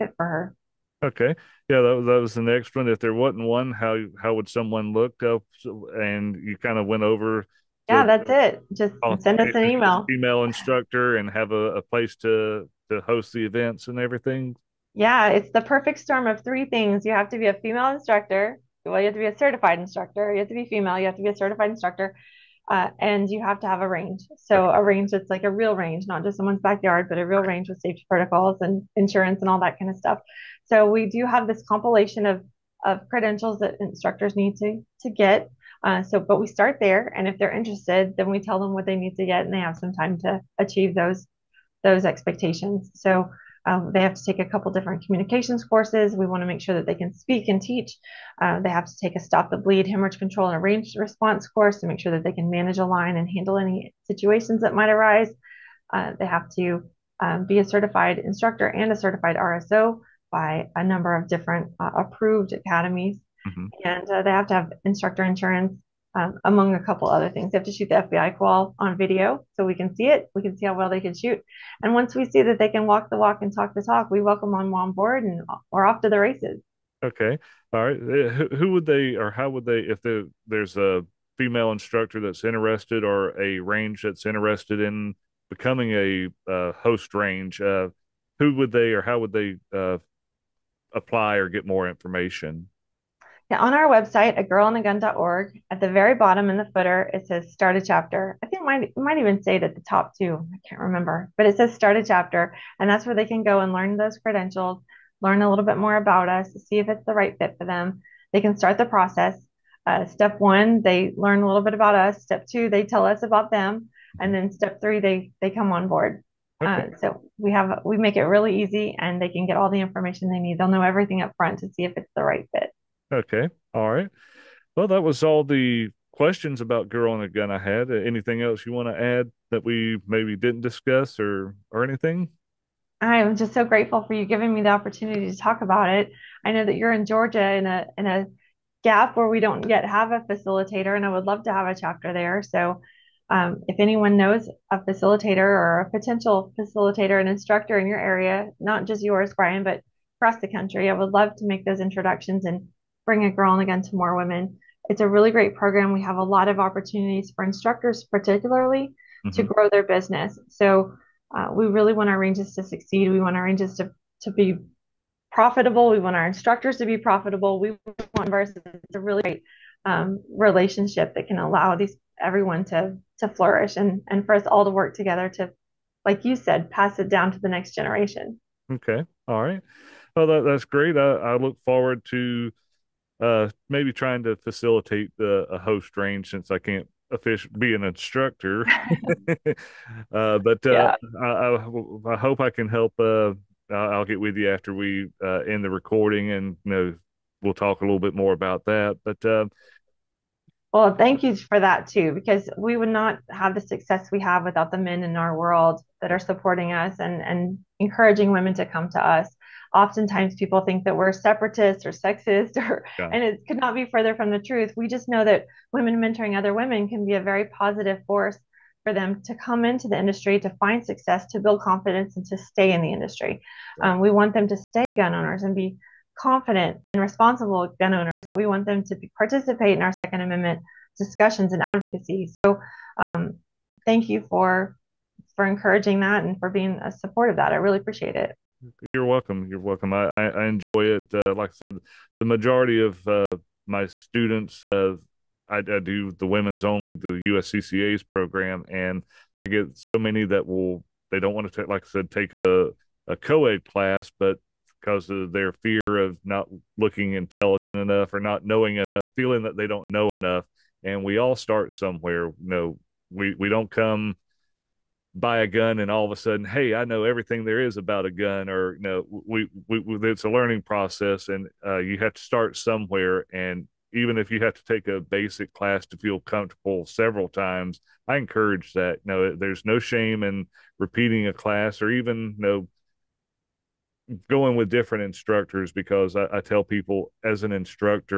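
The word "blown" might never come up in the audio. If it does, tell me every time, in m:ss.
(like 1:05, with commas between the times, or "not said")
not said.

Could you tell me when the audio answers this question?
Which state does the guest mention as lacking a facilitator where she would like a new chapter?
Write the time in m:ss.
2:17.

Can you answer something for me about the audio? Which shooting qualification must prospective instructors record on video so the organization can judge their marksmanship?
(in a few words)
FBI qual.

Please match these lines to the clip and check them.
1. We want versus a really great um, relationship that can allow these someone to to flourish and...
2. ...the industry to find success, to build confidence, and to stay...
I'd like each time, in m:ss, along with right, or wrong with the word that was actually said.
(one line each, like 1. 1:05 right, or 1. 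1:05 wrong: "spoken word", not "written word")
1. 2:47 wrong: "everyone", not "someone"
2. 3:39 right.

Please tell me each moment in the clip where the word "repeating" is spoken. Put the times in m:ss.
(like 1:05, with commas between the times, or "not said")
4:40.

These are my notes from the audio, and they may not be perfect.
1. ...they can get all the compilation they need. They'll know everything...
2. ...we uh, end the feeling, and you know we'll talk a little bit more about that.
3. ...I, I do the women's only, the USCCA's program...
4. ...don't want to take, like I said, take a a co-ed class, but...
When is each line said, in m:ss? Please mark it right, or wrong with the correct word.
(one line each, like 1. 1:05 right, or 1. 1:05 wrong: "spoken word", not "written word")
1. 1:59 wrong: "information", not "compilation"
2. 3:14 wrong: "recording", not "feeling"
3. 4:05 right
4. 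4:11 right.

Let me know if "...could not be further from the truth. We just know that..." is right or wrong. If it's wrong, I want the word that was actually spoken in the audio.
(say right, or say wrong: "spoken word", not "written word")
right.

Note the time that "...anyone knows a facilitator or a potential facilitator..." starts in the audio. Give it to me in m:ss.
2:23.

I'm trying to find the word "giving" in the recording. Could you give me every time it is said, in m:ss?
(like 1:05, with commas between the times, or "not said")
2:14.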